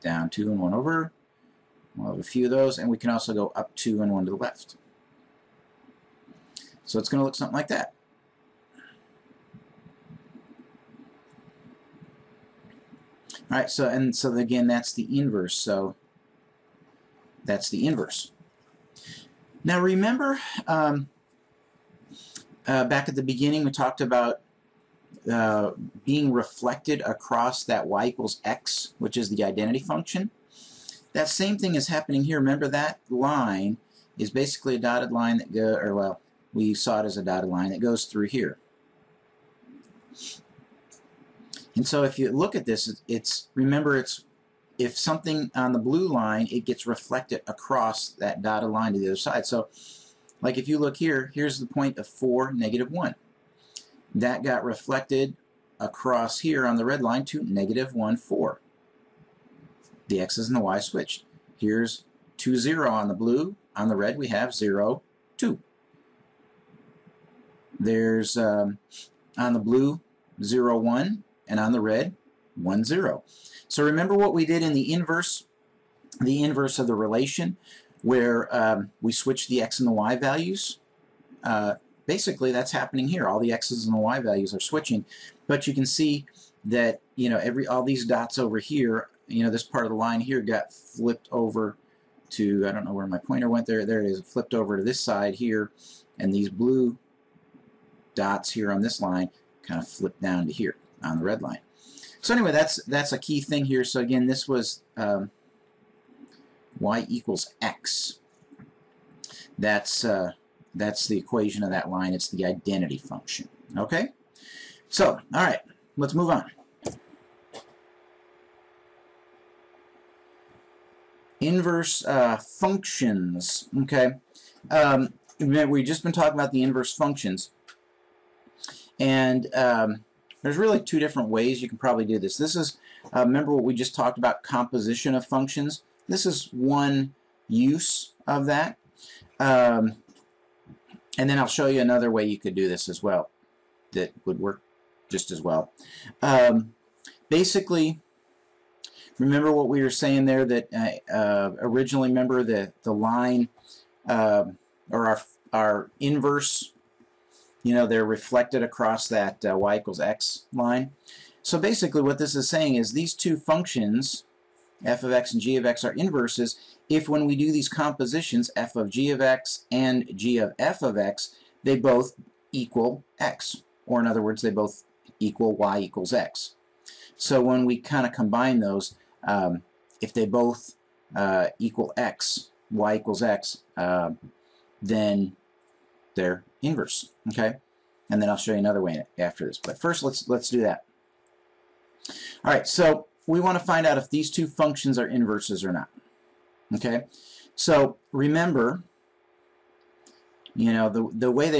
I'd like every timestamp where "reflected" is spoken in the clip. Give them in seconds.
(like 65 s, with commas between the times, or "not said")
26 s, 46 s, 54 s, 158 s.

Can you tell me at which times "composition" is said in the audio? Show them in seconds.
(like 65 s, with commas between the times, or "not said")
134 s, 167 s.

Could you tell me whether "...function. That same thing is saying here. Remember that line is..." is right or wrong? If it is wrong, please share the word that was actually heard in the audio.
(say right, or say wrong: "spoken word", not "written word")
wrong: "happening", not "saying".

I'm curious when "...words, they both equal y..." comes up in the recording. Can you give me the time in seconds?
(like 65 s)
174 s.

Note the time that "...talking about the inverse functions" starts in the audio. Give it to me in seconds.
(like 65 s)
126 s.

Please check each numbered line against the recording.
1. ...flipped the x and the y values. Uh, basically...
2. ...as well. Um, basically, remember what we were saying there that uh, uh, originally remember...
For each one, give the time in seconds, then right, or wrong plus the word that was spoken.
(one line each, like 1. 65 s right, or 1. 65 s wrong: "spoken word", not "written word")
1. 79 s wrong: "switched", not "flipped"
2. 145 s right.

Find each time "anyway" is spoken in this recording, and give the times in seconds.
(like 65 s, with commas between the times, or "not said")
102 s.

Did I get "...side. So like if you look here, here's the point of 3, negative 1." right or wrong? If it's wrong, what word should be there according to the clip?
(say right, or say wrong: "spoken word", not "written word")
wrong: "4", not "3".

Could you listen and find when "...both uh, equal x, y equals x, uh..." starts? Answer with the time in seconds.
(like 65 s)
180 s.